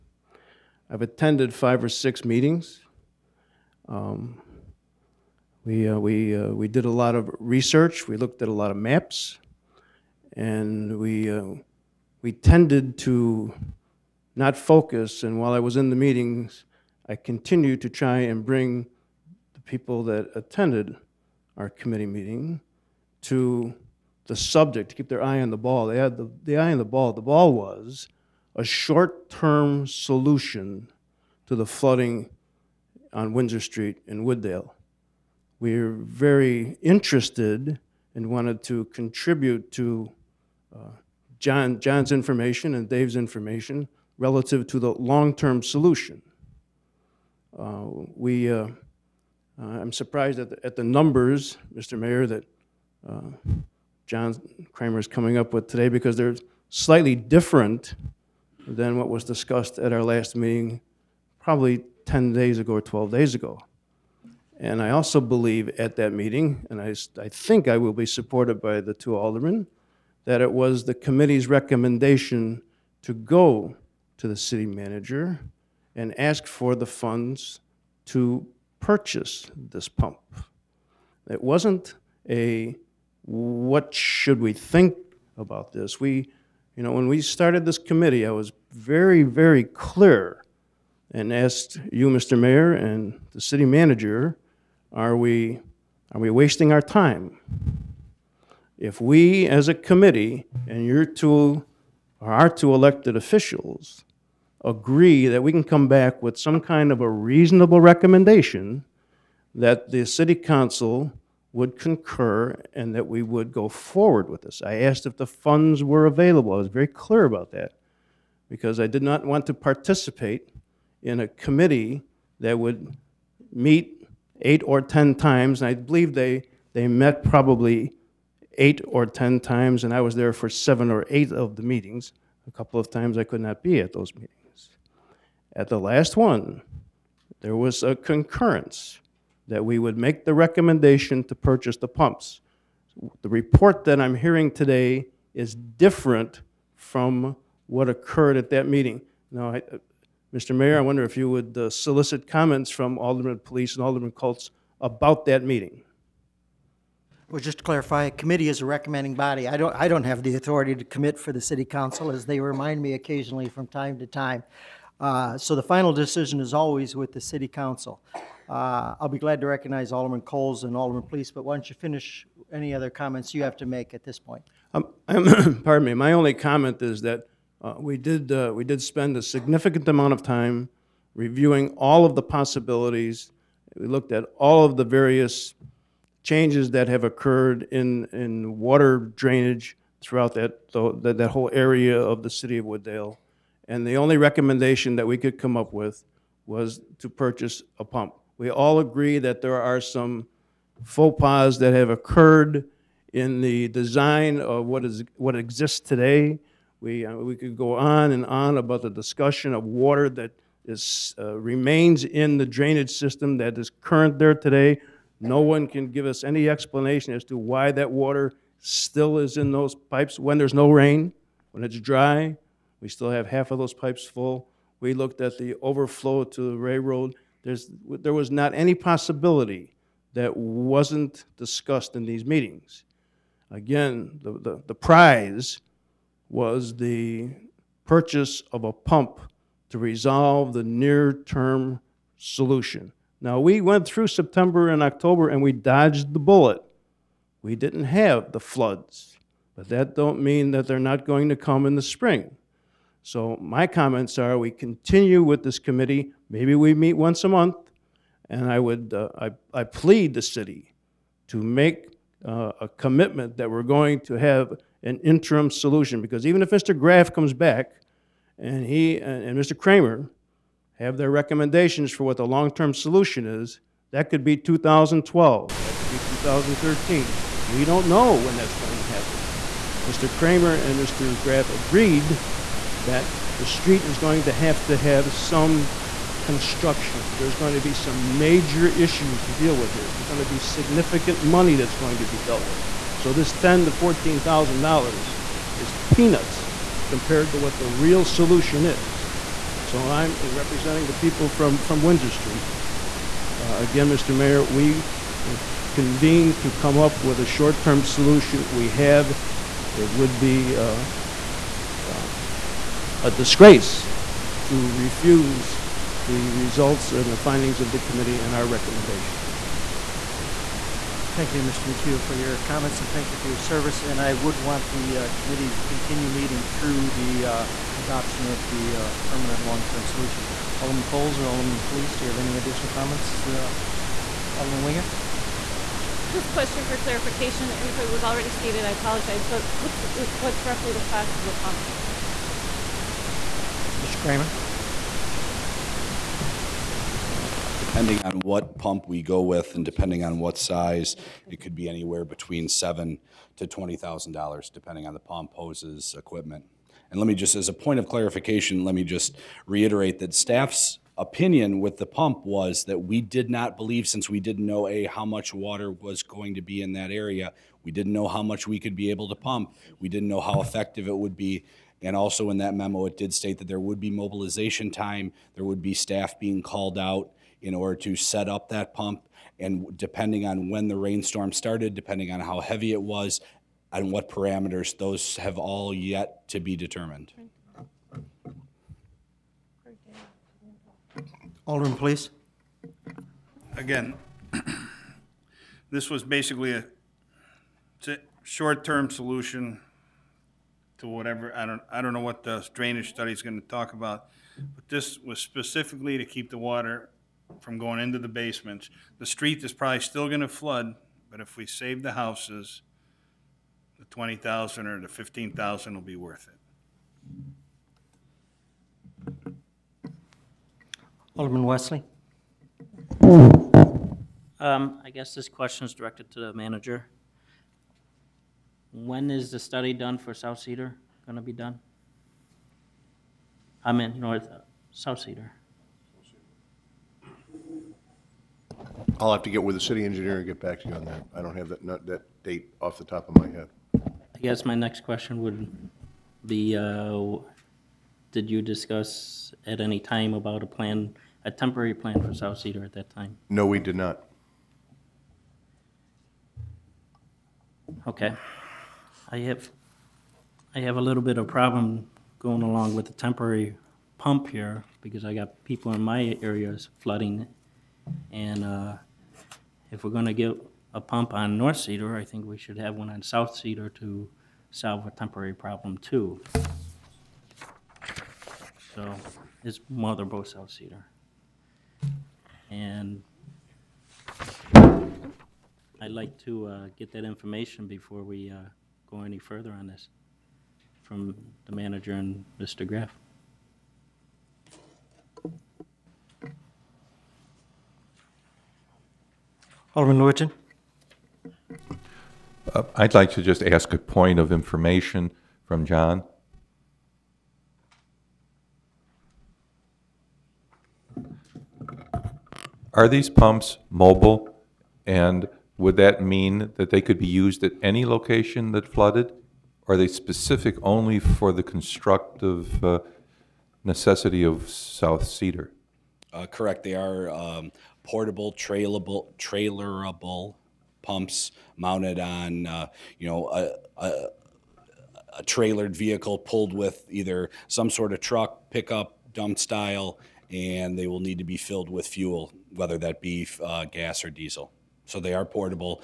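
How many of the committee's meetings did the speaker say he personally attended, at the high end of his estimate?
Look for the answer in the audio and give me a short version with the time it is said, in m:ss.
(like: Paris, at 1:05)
8, at 2:10.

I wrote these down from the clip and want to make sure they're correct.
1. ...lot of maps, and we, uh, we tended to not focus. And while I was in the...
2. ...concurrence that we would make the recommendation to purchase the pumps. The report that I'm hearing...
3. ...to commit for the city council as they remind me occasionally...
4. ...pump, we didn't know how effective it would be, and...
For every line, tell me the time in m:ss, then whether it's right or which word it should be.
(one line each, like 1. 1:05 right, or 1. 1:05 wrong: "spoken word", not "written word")
1. 0:08 right
2. 2:17 right
3. 2:40 right
4. 6:09 right.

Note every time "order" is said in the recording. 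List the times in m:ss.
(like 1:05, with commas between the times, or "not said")
6:17.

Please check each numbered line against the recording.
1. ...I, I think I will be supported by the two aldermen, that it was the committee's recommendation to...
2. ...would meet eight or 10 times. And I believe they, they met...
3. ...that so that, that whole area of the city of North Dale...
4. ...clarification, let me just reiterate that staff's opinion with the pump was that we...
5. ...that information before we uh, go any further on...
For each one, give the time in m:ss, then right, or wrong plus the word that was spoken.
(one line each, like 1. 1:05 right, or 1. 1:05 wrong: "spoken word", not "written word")
1. 1:06 right
2. 2:02 right
3. 3:10 wrong: "Wood", not "North"
4. 5:57 right
5. 8:06 right.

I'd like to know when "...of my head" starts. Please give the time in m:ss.
7:23.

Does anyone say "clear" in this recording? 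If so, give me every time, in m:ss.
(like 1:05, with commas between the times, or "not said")
1:29, 1:56.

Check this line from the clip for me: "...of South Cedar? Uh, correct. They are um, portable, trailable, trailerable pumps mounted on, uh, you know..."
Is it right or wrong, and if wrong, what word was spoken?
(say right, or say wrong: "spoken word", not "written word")
right.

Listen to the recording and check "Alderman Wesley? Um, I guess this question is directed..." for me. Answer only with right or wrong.
right.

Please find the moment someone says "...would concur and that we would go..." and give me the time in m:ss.
1:51.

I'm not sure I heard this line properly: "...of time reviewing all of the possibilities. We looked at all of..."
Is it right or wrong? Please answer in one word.
right.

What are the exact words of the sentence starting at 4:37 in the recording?
We don't know when that's going to happen.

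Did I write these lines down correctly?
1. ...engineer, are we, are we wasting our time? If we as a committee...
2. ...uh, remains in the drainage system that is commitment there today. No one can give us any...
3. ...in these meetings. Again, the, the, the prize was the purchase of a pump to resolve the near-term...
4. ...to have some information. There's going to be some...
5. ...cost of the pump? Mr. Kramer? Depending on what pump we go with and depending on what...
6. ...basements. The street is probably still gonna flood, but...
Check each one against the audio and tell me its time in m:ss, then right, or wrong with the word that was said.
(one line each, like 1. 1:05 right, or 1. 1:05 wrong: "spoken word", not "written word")
1. 1:33 wrong: "manager", not "engineer"
2. 3:31 wrong: "current", not "commitment"
3. 3:51 right
4. 4:44 wrong: "construction", not "information"
5. 5:40 right
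6. 6:48 right.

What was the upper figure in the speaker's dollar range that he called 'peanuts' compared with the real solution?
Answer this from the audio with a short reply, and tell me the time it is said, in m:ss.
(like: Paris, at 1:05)
$14,000, at 4:53.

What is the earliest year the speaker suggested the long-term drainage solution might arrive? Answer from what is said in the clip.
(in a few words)
2012.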